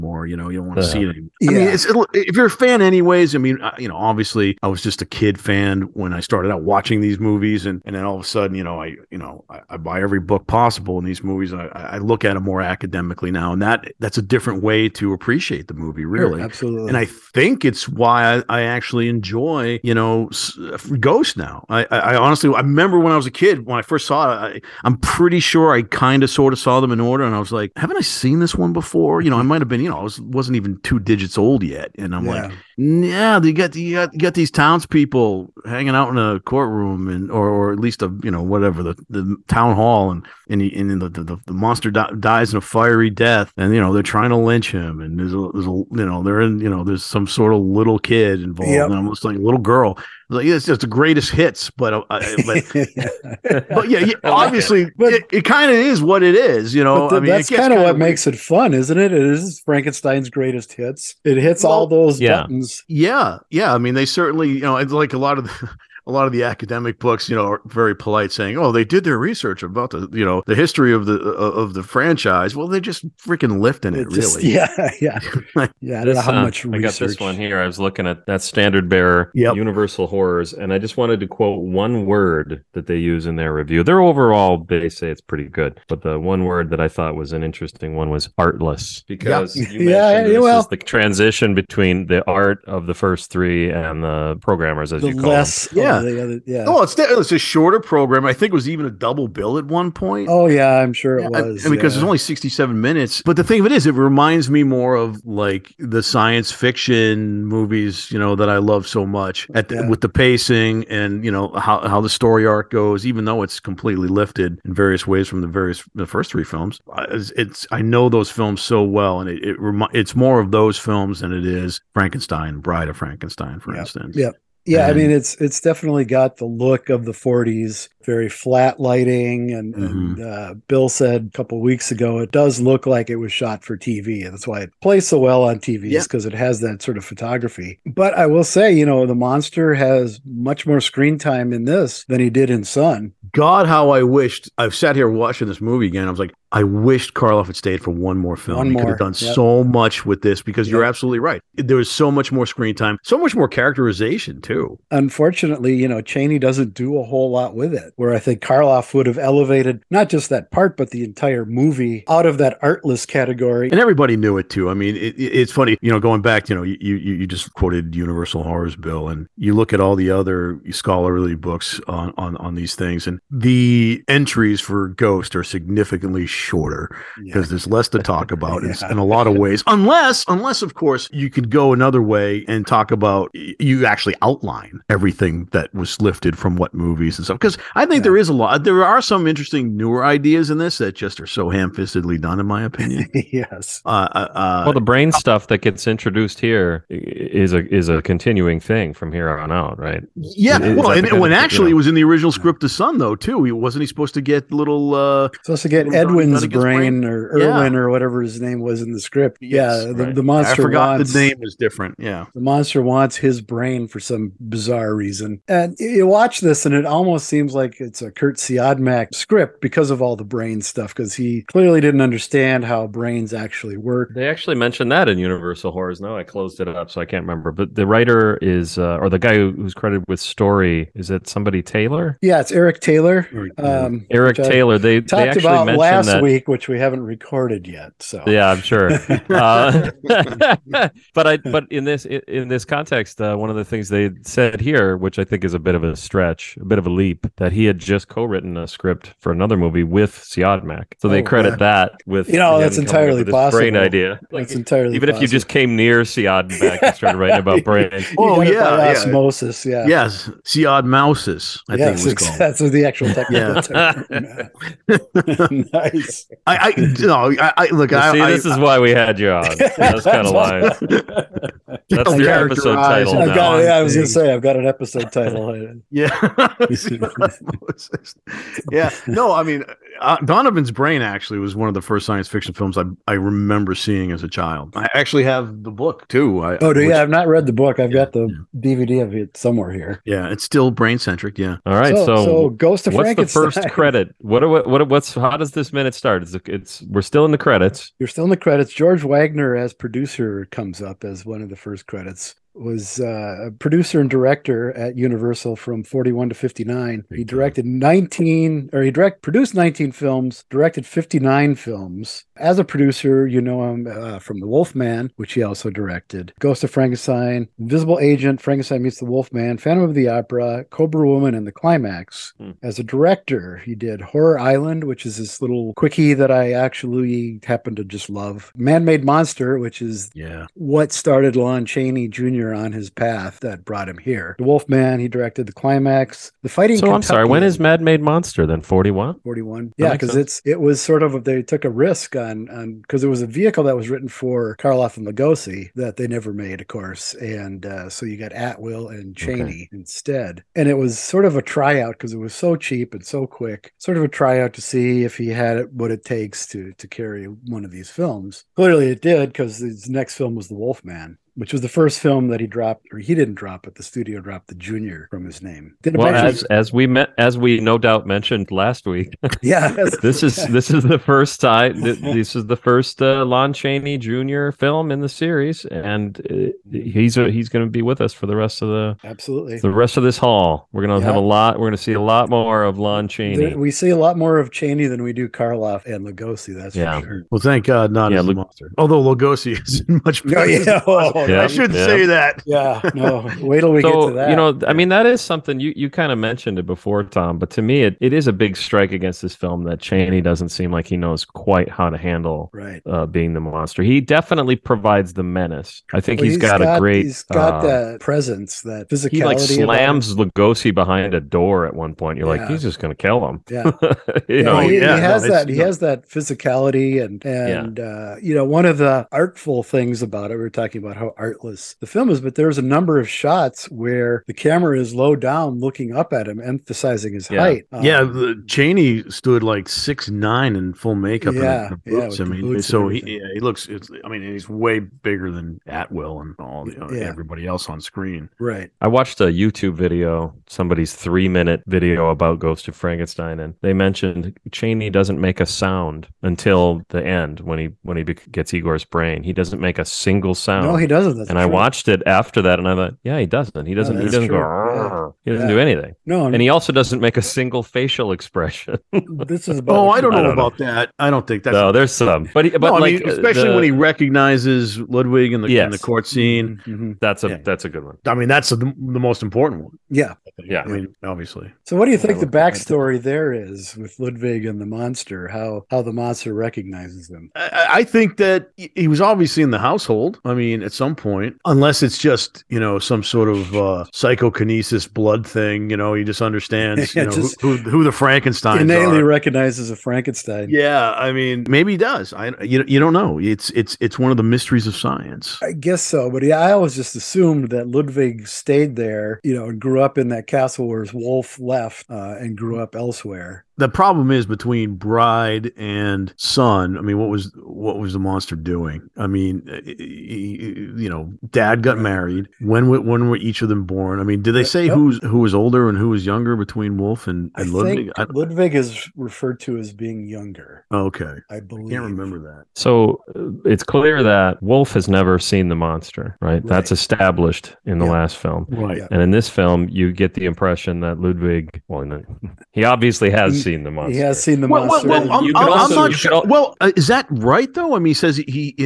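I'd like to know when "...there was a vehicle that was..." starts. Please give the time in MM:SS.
05:43.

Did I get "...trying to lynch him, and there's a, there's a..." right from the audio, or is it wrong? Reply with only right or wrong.
right.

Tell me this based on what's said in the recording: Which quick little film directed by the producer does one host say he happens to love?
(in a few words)
Horror Island.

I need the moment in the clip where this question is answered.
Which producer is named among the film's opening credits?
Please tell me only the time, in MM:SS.
04:58.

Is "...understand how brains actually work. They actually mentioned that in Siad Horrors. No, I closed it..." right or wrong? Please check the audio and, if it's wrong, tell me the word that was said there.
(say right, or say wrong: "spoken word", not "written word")
wrong: "Universal", not "Siad".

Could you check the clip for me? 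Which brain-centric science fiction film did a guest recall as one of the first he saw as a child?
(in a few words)
Donovan's Brain.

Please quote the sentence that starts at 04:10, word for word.
So they oh, credit that with you know that's entirely possible.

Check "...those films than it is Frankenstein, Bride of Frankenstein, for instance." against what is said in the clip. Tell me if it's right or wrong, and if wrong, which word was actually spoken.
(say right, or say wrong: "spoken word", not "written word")
right.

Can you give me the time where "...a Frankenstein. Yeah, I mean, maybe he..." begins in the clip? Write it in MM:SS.
08:09.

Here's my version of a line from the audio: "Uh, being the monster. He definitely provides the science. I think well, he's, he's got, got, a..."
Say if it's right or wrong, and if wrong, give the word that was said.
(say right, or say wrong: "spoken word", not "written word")
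wrong: "menace", not "science".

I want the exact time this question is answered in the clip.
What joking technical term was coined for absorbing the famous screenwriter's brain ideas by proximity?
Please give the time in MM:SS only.
04:20.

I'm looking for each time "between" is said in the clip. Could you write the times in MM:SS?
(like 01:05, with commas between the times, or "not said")
01:31, 08:24, 08:36.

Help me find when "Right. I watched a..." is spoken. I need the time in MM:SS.
07:18.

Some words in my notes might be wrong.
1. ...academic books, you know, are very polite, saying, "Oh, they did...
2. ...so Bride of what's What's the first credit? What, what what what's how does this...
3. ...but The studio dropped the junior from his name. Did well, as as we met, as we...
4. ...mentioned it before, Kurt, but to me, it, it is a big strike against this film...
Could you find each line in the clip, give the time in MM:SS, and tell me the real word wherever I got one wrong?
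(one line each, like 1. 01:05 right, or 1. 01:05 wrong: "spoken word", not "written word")
1. 01:06 right
2. 04:52 wrong: "Ghost", not "Bride"
3. 06:03 right
4. 06:36 wrong: "Thom", not "Kurt".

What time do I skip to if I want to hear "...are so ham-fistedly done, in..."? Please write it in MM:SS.
03:11.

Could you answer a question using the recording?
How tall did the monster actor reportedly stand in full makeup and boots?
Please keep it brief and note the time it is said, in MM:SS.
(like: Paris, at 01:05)
six nine, at 07:09.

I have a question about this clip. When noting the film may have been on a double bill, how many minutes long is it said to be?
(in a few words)
67.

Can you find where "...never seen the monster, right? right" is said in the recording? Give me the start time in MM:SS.
08:44.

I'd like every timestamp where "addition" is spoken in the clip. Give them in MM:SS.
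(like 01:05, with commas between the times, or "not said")
not said.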